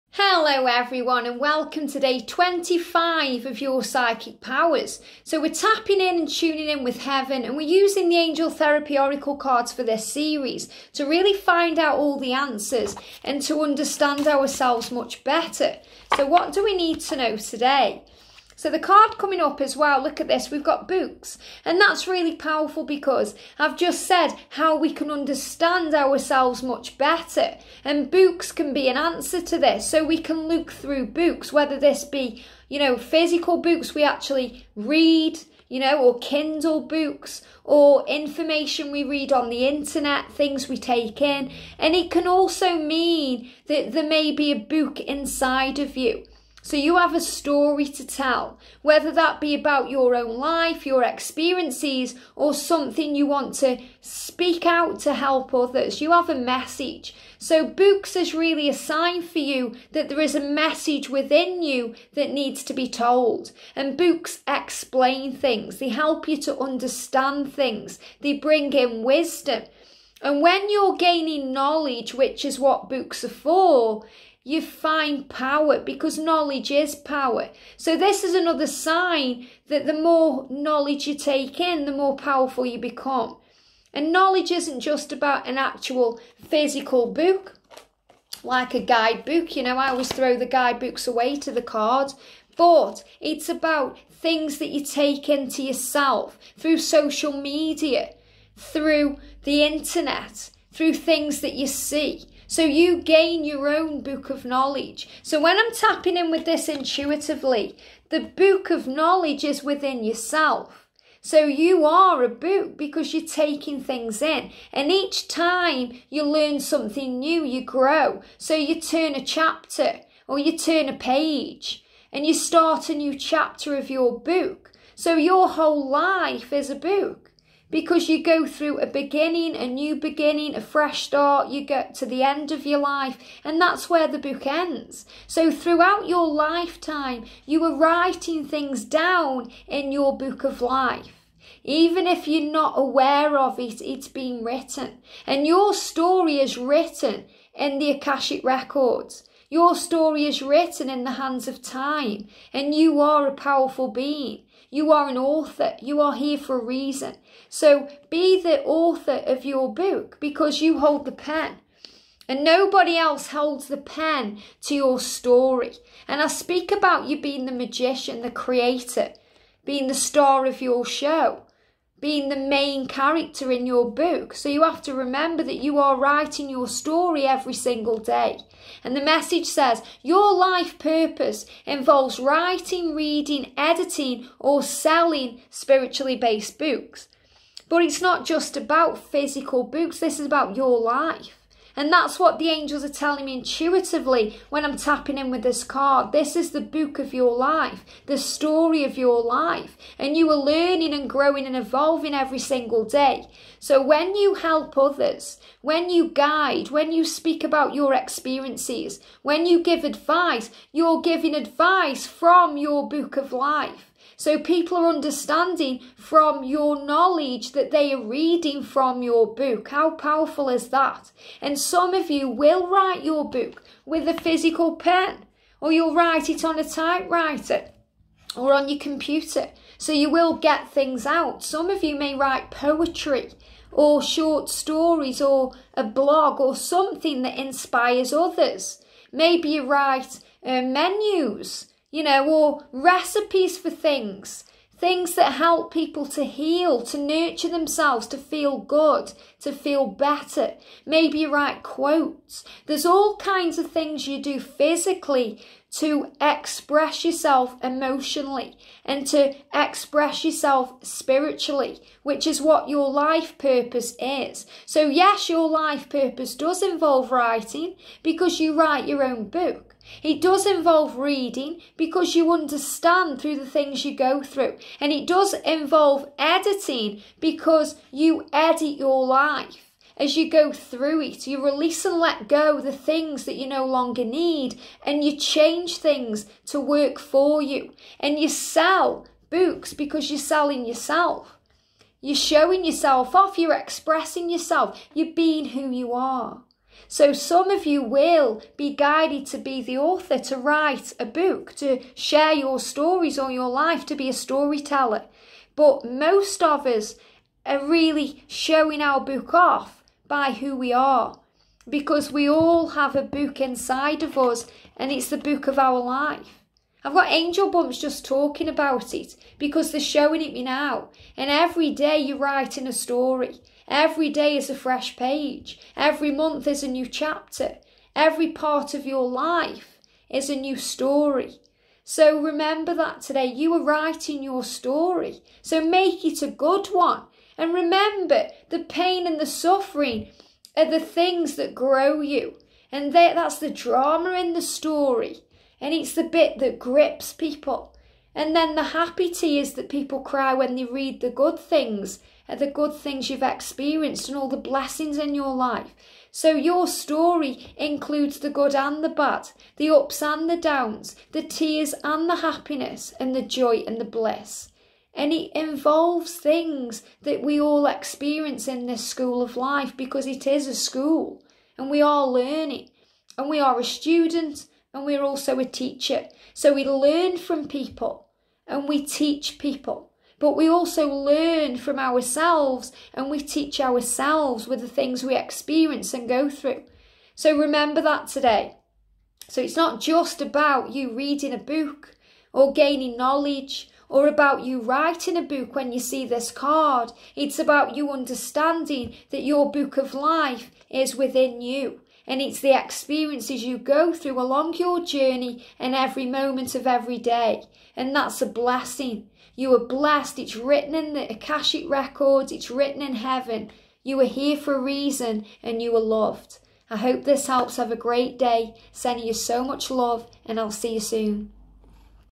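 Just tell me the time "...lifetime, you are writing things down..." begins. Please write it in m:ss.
2:16.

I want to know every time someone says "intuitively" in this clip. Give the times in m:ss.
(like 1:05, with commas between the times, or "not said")
1:46, 3:13.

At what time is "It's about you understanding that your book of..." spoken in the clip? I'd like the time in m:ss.
6:37.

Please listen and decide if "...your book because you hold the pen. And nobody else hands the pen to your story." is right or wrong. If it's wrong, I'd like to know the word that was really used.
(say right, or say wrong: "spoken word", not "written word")
wrong: "holds", not "hands".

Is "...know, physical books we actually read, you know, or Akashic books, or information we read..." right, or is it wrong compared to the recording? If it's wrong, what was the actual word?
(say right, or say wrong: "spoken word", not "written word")
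wrong: "Kindle", not "Akashic".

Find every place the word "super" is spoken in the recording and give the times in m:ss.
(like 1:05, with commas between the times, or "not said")
not said.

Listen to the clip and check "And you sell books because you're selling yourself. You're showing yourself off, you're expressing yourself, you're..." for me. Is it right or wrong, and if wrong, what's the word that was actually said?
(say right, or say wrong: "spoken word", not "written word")
right.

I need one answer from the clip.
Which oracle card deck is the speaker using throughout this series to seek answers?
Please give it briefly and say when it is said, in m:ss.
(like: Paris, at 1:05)
Angel therapy oracle cards, at 0:08.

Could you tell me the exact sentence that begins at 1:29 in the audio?
You know, I always throw the guidebooks away to the card.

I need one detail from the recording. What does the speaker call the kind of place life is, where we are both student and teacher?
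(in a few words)
School of life.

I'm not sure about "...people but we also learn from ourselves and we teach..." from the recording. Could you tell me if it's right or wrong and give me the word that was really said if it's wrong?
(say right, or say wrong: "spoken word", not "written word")
right.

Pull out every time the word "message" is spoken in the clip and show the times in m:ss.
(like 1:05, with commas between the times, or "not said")
0:56, 1:00, 2:59.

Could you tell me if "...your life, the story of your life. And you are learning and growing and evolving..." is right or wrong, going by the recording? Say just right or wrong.
right.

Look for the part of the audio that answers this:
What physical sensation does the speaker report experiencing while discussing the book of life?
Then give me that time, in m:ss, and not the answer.
5:17.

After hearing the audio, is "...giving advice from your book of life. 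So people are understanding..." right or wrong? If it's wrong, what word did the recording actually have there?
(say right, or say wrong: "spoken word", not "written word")
right.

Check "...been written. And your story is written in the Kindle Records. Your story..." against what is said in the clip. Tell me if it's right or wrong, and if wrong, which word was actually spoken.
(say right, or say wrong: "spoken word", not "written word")
wrong: "Akashic", not "Kindle".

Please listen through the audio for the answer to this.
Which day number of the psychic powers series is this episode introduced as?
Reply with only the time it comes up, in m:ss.
0:01.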